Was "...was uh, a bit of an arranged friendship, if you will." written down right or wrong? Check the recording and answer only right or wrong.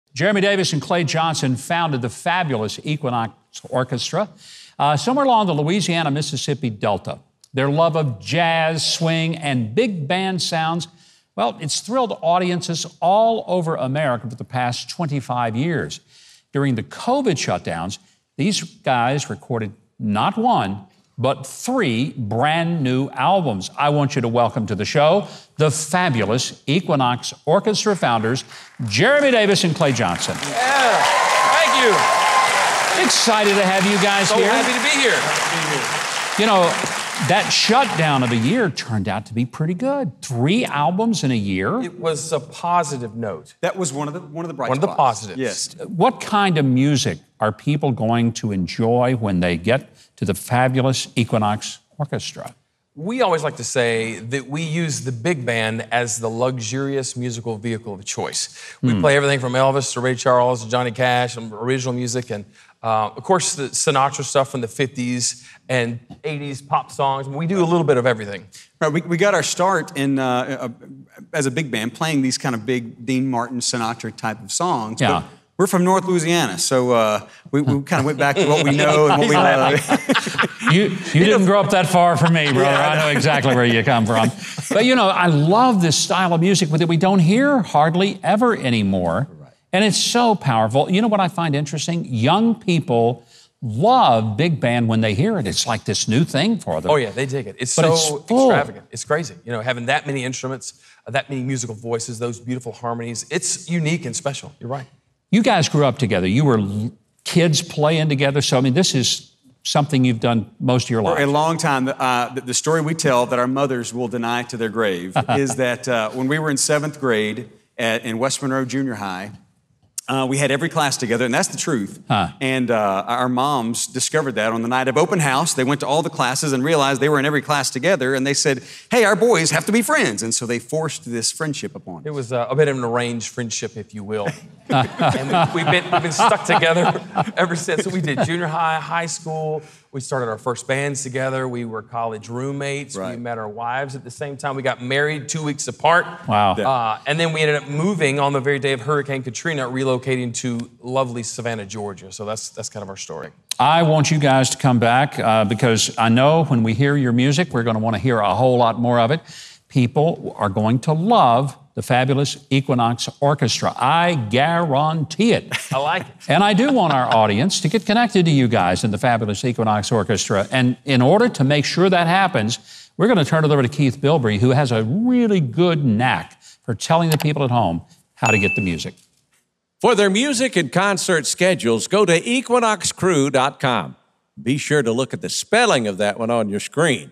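right.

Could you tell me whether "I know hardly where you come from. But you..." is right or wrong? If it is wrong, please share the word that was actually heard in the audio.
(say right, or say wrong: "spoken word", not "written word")
wrong: "exactly", not "hardly".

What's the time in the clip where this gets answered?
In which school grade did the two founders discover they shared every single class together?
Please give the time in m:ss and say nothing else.
1:56.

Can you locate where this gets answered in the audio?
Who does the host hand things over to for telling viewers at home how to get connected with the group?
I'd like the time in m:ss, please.
2:53.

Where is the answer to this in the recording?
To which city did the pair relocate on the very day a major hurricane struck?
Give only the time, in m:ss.
2:31.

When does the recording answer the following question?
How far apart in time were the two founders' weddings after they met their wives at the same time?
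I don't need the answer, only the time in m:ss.
2:25.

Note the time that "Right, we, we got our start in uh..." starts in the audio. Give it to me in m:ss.
1:08.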